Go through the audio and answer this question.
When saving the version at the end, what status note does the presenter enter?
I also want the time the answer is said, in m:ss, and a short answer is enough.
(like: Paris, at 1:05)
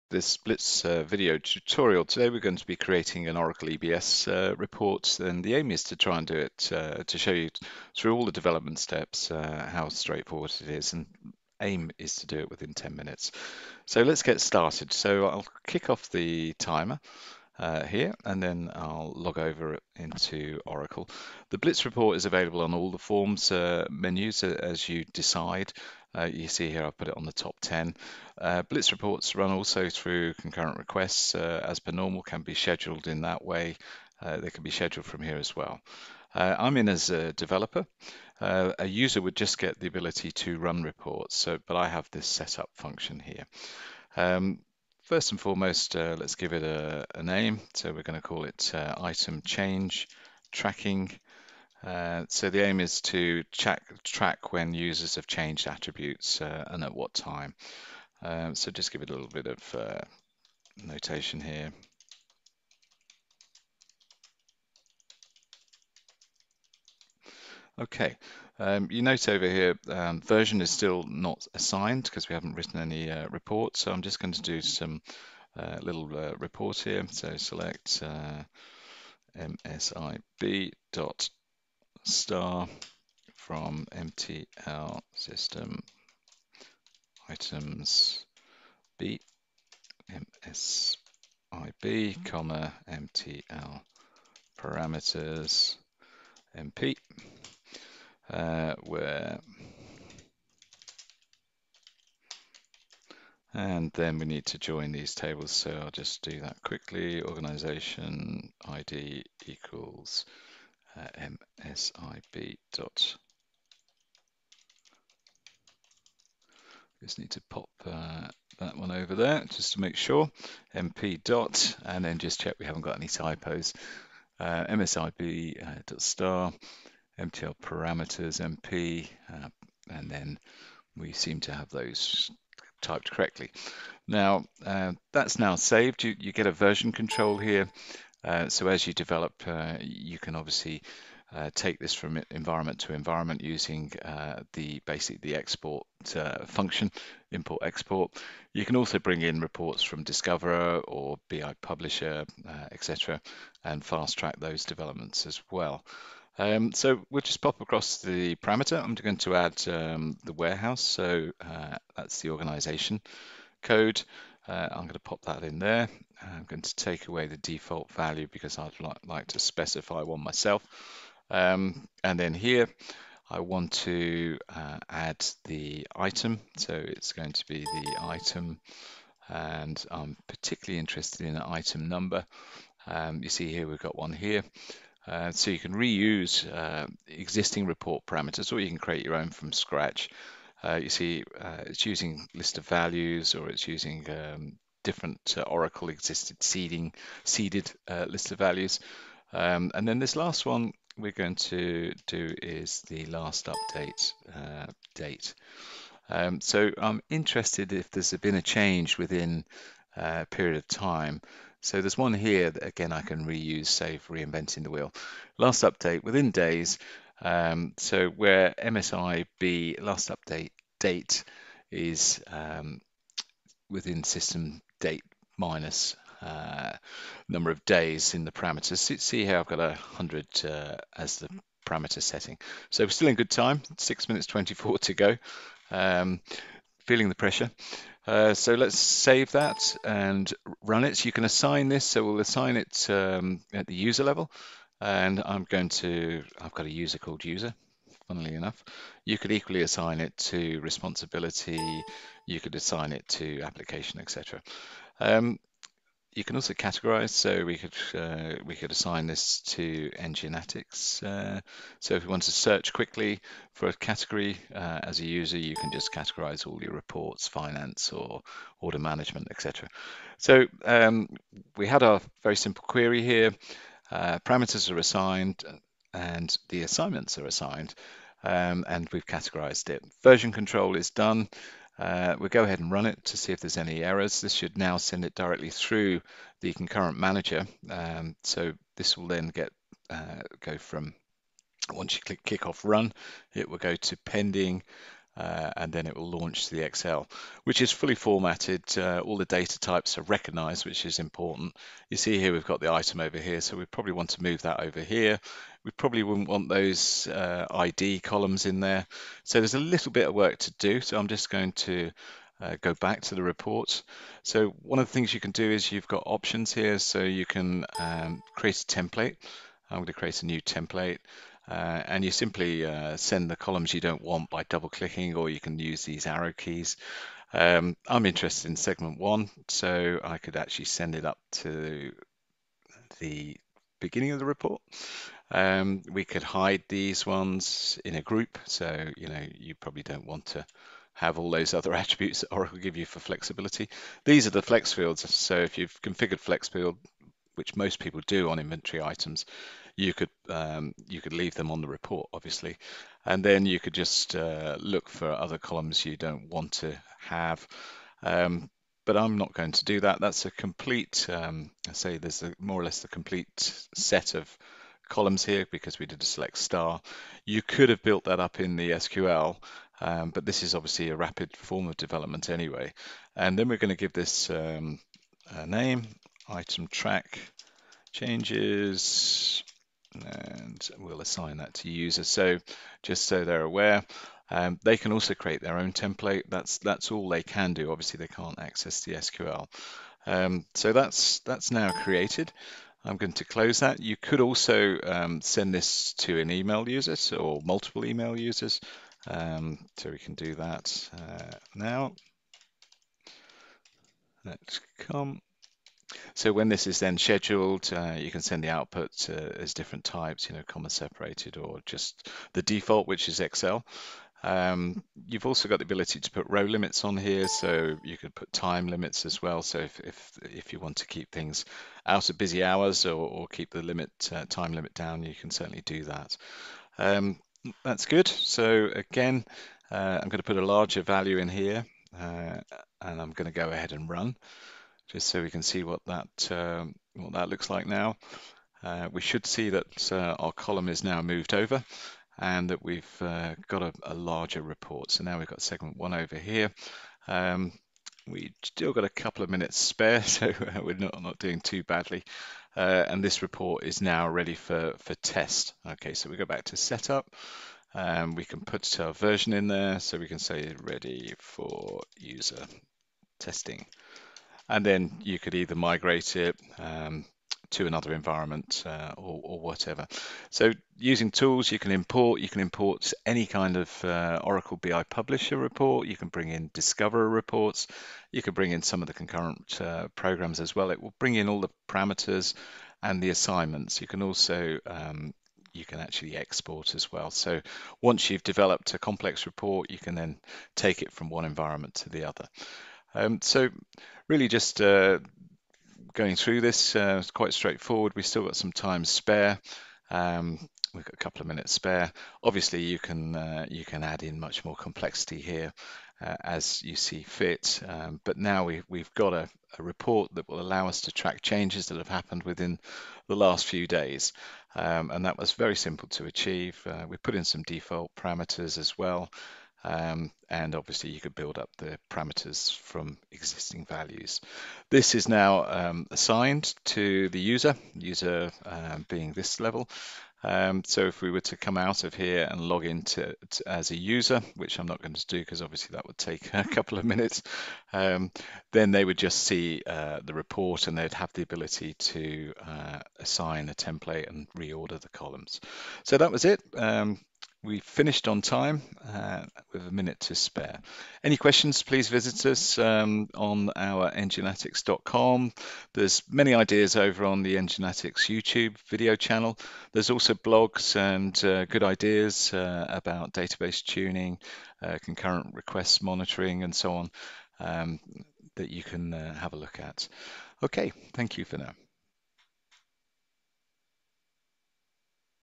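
Ready for user testing, at 7:40.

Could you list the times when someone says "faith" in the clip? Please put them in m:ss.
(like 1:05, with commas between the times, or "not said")
not said.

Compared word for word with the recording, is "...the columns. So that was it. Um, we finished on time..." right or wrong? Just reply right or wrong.
right.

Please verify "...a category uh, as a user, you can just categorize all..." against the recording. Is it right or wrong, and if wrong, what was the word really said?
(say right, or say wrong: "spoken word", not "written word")
right.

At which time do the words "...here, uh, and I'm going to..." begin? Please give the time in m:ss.
7:11.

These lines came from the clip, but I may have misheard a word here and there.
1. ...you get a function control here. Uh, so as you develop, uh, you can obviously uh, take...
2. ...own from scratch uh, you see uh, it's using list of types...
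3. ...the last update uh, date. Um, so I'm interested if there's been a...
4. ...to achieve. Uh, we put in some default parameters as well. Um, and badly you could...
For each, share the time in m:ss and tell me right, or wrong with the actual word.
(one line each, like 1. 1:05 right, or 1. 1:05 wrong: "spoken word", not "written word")
1. 2:16 wrong: "version", not "function"
2. 3:09 wrong: "values", not "types"
3. 3:22 right
4. 8:35 wrong: "obviously", not "badly".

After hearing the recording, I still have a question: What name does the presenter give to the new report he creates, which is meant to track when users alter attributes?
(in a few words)
Item change tracking.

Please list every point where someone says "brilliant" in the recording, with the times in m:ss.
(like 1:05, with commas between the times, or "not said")
not said.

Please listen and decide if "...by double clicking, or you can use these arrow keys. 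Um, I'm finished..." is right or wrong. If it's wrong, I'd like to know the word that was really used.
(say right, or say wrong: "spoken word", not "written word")
wrong: "interested", not "finished".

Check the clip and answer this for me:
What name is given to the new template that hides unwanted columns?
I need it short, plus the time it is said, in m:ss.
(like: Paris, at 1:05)
Item track changes, at 6:16.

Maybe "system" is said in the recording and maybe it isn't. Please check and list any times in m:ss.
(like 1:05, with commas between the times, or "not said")
1:25, 3:44.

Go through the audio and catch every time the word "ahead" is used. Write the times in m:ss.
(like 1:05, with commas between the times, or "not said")
4:42, 7:13.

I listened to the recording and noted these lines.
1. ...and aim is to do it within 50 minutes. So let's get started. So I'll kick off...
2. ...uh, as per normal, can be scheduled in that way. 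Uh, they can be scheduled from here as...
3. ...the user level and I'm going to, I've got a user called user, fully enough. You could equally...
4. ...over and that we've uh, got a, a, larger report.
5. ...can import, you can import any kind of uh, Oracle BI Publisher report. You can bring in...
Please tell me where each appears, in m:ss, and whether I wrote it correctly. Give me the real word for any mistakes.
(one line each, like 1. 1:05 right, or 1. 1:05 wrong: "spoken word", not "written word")
1. 0:10 wrong: "10", not "50"
2. 0:31 right
3. 4:03 wrong: "funnily", not "fully"
4. 7:21 right
5. 7:51 right.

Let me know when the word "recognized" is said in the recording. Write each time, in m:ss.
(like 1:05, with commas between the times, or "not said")
5:00.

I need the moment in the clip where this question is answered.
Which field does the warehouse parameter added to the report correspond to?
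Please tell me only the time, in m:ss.
2:42.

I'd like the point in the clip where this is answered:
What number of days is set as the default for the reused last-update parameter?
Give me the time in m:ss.
3:49.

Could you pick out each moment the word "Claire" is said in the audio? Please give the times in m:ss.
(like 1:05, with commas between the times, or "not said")
not said.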